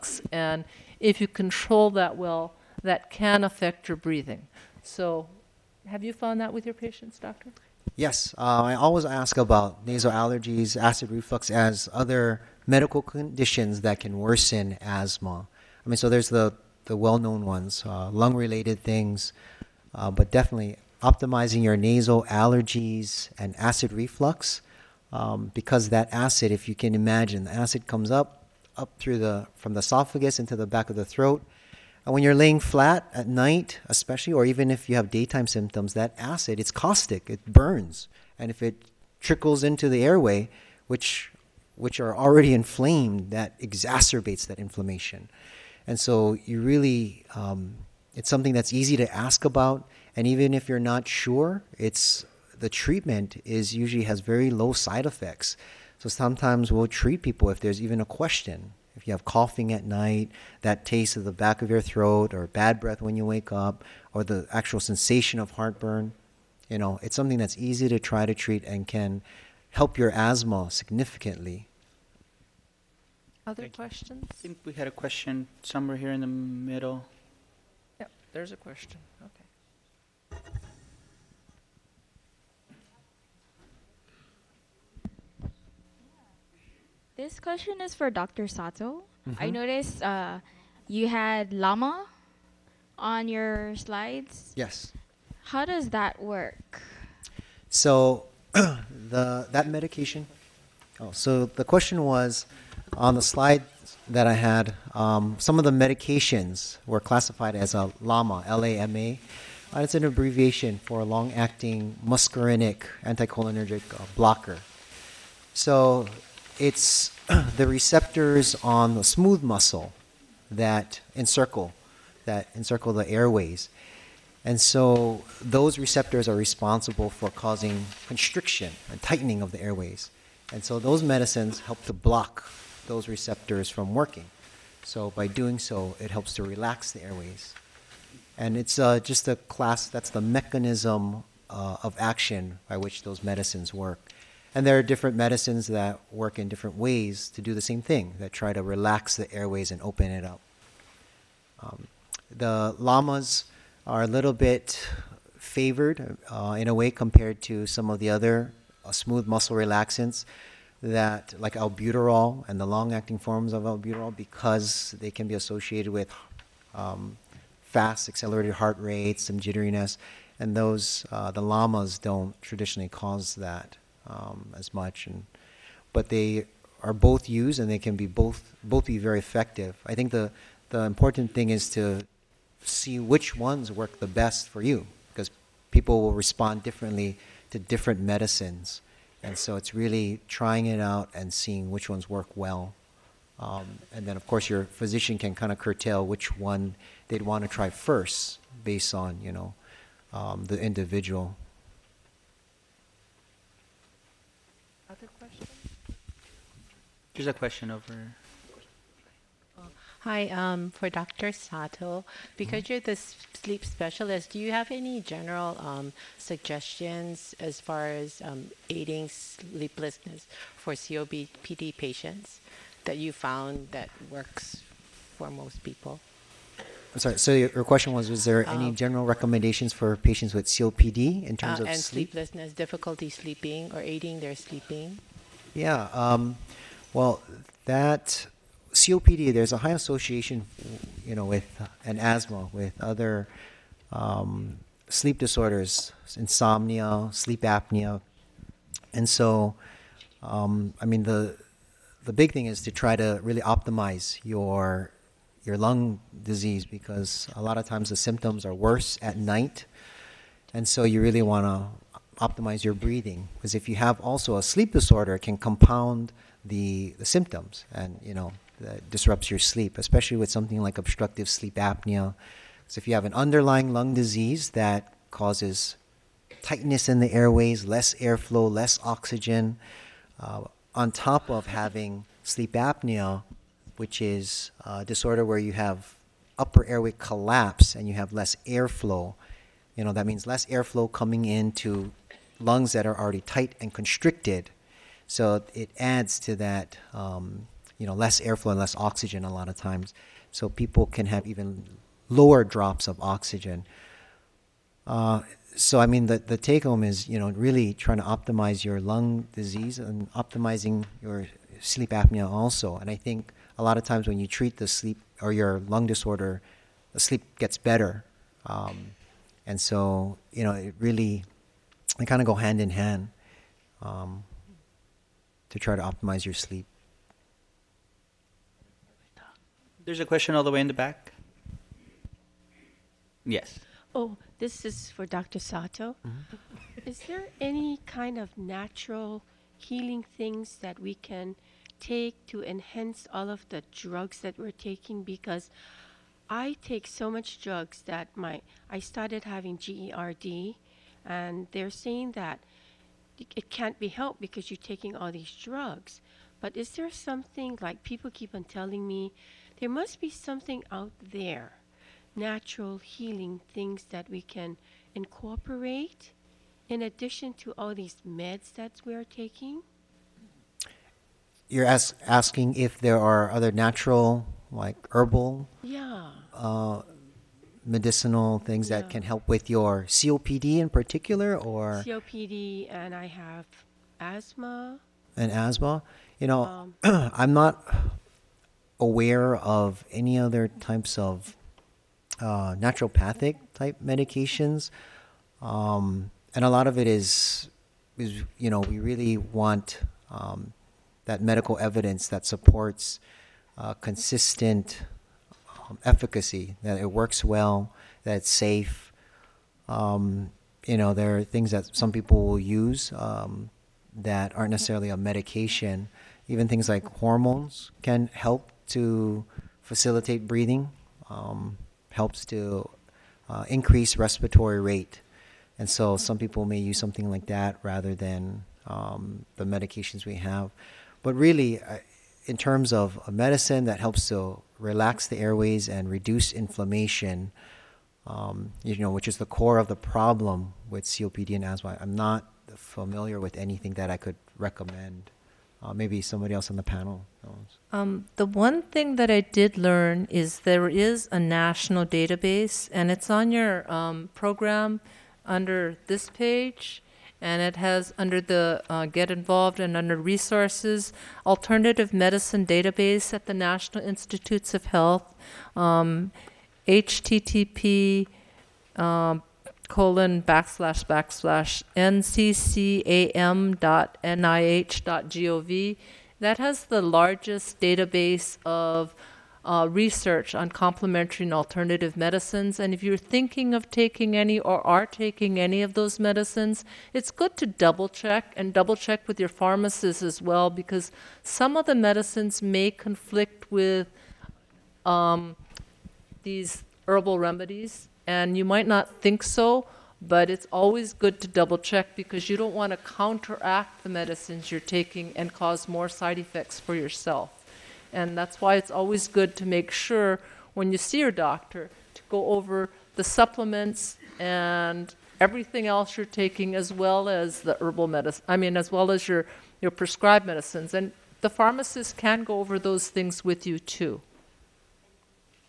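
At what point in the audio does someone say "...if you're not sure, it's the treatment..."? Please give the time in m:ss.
0:50.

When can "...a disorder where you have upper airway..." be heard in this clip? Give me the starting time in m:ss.
4:44.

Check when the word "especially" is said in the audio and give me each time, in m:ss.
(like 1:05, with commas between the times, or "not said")
0:33, 4:29.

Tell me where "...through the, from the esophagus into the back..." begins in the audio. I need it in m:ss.
0:28.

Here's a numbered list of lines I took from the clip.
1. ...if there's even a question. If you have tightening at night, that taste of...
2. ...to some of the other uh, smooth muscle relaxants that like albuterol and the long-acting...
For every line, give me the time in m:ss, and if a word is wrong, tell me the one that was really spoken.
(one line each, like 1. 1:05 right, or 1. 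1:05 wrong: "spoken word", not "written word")
1. 0:57 wrong: "coughing", not "tightening"
2. 2:37 right.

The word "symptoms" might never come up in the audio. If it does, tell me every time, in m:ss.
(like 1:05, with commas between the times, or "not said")
0:35, 4:17, 4:27.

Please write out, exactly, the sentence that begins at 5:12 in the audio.
And I think a lot of times when you treat the sleep or your lung disorder, the sleep gets better.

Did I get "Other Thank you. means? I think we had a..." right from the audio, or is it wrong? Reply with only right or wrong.
wrong.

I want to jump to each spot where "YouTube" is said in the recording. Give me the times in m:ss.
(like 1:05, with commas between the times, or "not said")
not said.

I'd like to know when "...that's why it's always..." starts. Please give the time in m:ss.
8:28.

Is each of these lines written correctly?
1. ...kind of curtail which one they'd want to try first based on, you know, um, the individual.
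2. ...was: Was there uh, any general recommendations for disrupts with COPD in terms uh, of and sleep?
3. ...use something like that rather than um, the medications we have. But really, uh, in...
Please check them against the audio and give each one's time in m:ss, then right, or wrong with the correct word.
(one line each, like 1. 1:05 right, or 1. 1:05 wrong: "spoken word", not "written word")
1. 3:15 right
2. 3:47 wrong: "patients", not "disrupts"
3. 7:06 right.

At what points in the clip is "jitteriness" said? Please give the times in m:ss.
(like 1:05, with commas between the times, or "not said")
2:49.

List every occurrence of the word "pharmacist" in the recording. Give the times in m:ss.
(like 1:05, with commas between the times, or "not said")
8:09, 8:41.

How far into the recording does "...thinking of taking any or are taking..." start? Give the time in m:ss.
8:02.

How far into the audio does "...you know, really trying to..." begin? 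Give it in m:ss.
5:07.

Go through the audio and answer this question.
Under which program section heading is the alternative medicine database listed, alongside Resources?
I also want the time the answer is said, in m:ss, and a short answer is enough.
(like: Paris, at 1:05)
Get Involved, at 7:38.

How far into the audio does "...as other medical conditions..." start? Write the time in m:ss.
0:11.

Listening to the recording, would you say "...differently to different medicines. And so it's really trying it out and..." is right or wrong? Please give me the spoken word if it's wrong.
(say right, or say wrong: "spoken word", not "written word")
right.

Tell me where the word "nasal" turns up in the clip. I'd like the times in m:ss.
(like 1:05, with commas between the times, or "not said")
0:09, 0:21.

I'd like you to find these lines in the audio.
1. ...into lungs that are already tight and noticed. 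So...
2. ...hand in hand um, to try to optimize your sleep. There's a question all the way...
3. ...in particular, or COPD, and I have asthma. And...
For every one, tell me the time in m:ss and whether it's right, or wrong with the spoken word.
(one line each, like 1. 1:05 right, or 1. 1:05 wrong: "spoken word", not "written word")
1. 4:51 wrong: "constricted", not "noticed"
2. 5:22 right
3. 6:20 right.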